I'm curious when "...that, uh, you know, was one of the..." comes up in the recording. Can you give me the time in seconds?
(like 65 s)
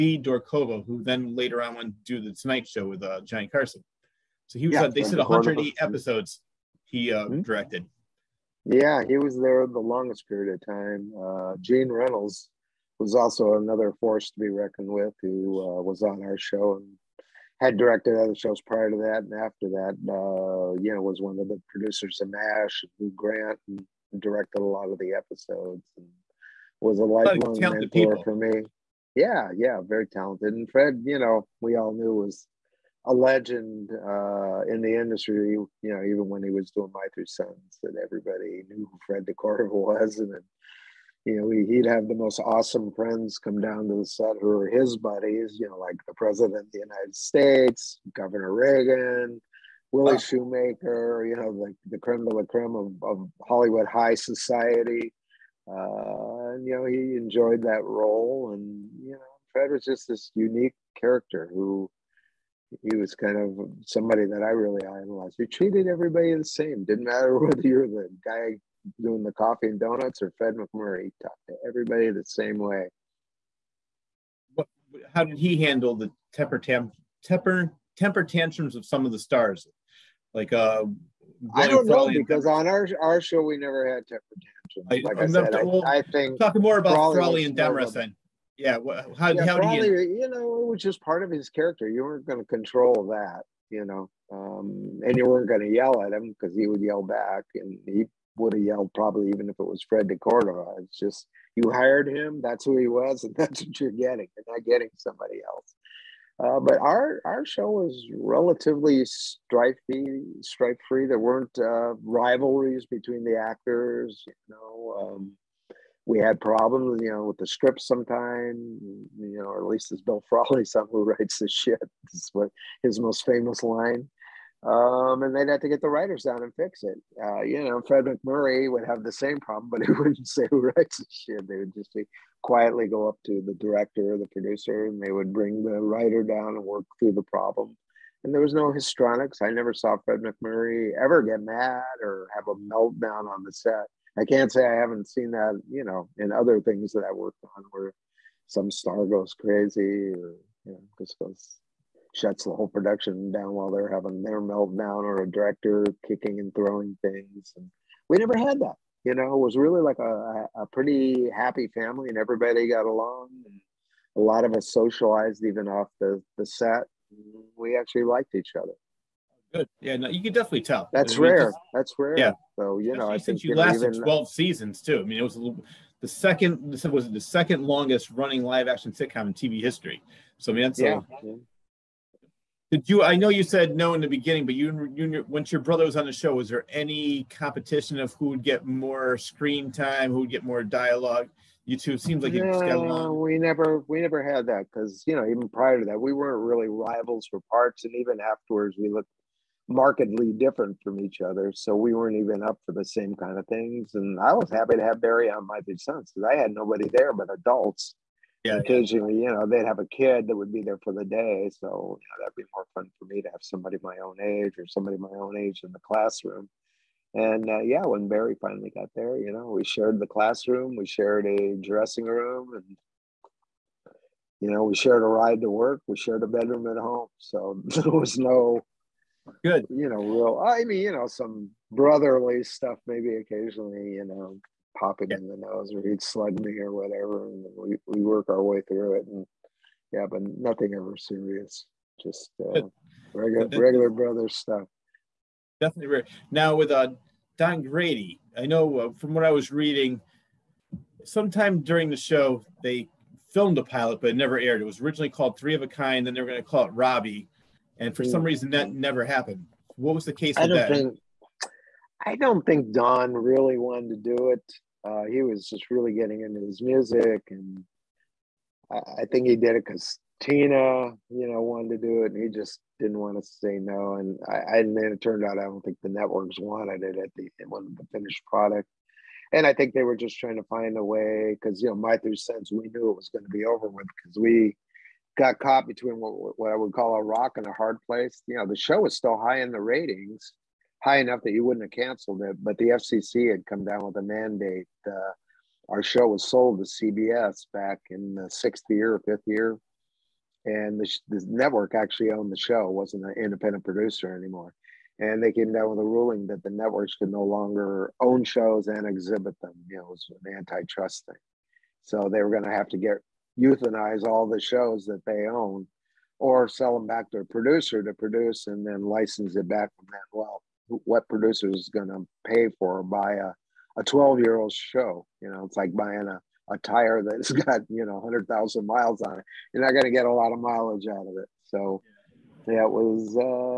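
19 s.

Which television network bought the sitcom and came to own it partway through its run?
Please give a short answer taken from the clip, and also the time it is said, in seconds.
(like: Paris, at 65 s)
CBS, at 296 s.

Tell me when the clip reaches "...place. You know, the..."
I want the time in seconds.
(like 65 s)
287 s.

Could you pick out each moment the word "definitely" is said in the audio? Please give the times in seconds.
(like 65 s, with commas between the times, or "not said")
170 s, 245 s.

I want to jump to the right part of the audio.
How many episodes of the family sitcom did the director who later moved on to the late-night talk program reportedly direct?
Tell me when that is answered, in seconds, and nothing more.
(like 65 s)
5 s.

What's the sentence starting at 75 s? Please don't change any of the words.
how did he handle the temper, tam, temper, temper tantrums of some of the stars?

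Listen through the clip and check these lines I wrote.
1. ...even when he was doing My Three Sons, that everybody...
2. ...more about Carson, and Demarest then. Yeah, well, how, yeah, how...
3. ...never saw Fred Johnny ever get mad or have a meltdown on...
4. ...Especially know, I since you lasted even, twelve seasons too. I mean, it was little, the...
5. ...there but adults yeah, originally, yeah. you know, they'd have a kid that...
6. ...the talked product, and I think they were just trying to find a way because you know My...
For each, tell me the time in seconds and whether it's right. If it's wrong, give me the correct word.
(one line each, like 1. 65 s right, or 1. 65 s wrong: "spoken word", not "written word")
1. 36 s right
2. 86 s wrong: "Frawley", not "Carson"
3. 139 s wrong: "MacMurray", not "Johnny"
4. 172 s right
5. 206 s wrong: "occasionally", not "originally"
6. 277 s wrong: "finished", not "talked".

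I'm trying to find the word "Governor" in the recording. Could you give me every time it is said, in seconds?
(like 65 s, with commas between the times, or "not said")
48 s.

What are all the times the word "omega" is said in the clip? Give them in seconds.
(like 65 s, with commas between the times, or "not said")
not said.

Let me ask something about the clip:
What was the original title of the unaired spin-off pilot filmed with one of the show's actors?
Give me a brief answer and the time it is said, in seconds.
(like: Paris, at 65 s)
Three of a Kind, at 255 s.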